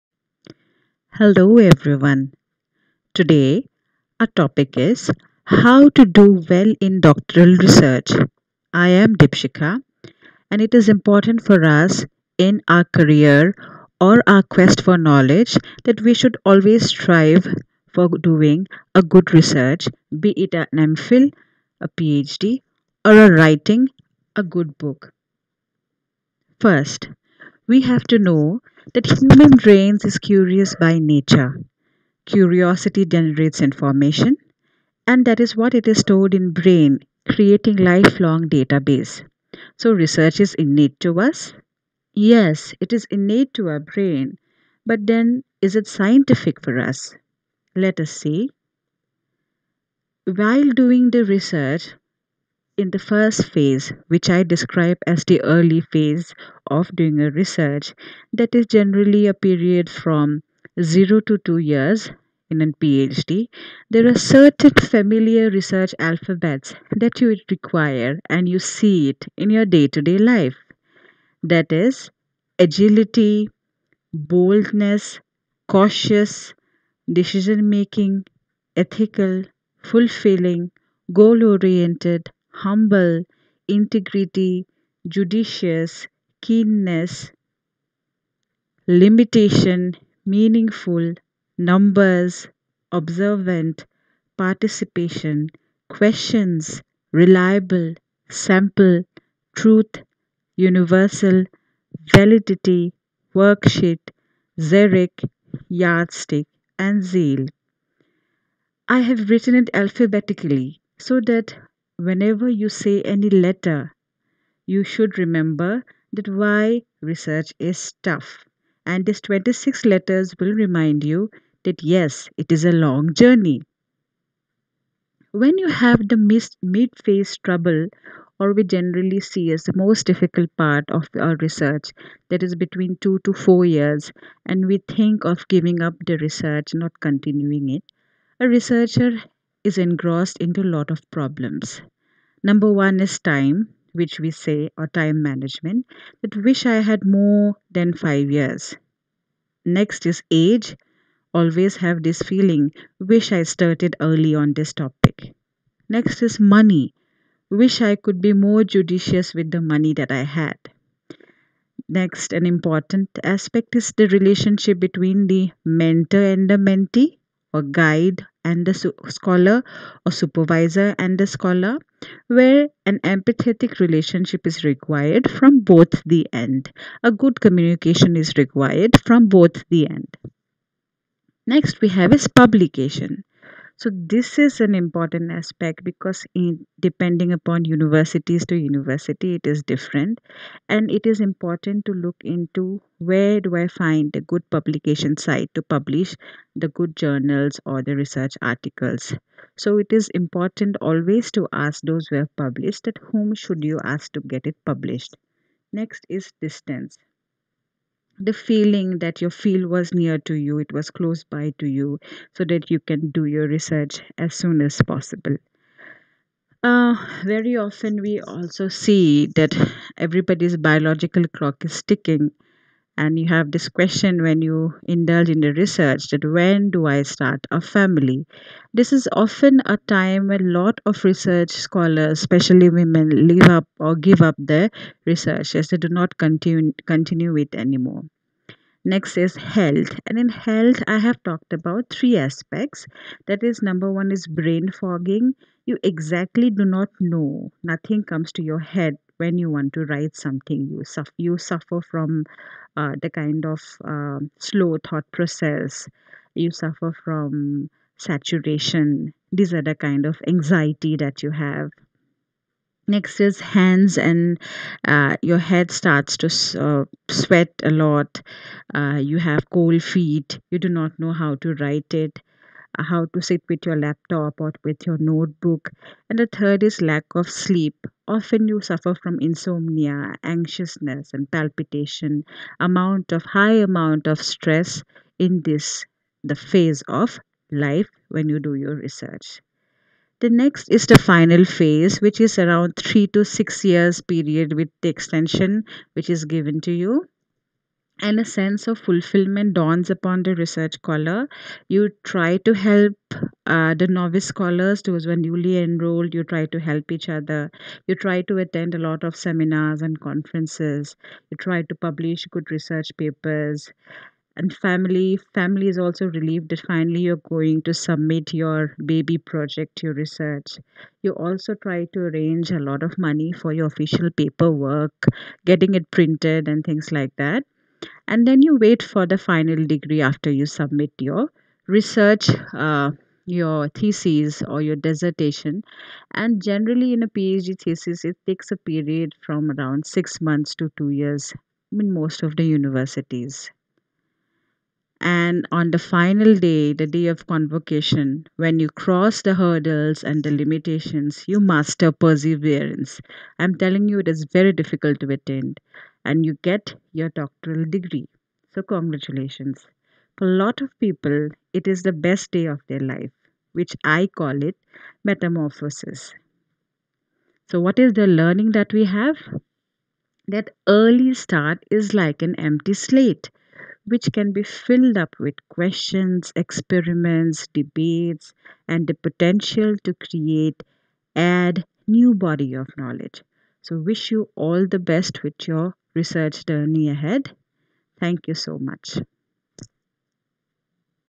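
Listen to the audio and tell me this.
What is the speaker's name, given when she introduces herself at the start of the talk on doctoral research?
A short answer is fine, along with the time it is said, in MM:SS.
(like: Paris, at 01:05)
Deepshikha, at 00:09.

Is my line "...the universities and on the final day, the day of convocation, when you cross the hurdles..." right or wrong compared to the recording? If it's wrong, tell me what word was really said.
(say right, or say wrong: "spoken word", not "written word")
right.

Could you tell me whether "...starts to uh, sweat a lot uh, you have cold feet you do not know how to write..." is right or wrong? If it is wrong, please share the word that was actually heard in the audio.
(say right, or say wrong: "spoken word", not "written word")
right.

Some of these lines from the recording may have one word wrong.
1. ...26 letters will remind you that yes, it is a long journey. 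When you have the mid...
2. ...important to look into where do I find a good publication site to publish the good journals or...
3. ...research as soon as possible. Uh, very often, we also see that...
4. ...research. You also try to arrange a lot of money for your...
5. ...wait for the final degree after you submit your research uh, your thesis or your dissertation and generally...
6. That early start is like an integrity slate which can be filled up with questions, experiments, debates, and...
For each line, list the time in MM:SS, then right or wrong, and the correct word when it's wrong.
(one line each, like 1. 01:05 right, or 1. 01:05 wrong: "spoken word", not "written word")
1. 01:59 right
2. 03:11 right
3. 03:33 right
4. 05:19 right
5. 05:28 right
6. 06:10 wrong: "empty", not "integrity".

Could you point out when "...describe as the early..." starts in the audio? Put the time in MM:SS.
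00:54.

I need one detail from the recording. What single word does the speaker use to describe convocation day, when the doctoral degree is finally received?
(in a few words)
metamorphosis.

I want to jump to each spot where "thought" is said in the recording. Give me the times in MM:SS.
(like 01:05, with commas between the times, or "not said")
04:14.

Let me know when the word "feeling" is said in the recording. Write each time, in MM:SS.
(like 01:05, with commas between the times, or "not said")
02:32, 03:28.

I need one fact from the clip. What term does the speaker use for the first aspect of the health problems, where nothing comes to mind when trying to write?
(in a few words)
brain fogging.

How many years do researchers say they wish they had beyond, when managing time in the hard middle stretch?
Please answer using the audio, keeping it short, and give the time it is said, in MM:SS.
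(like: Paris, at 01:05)
5 years, at 02:27.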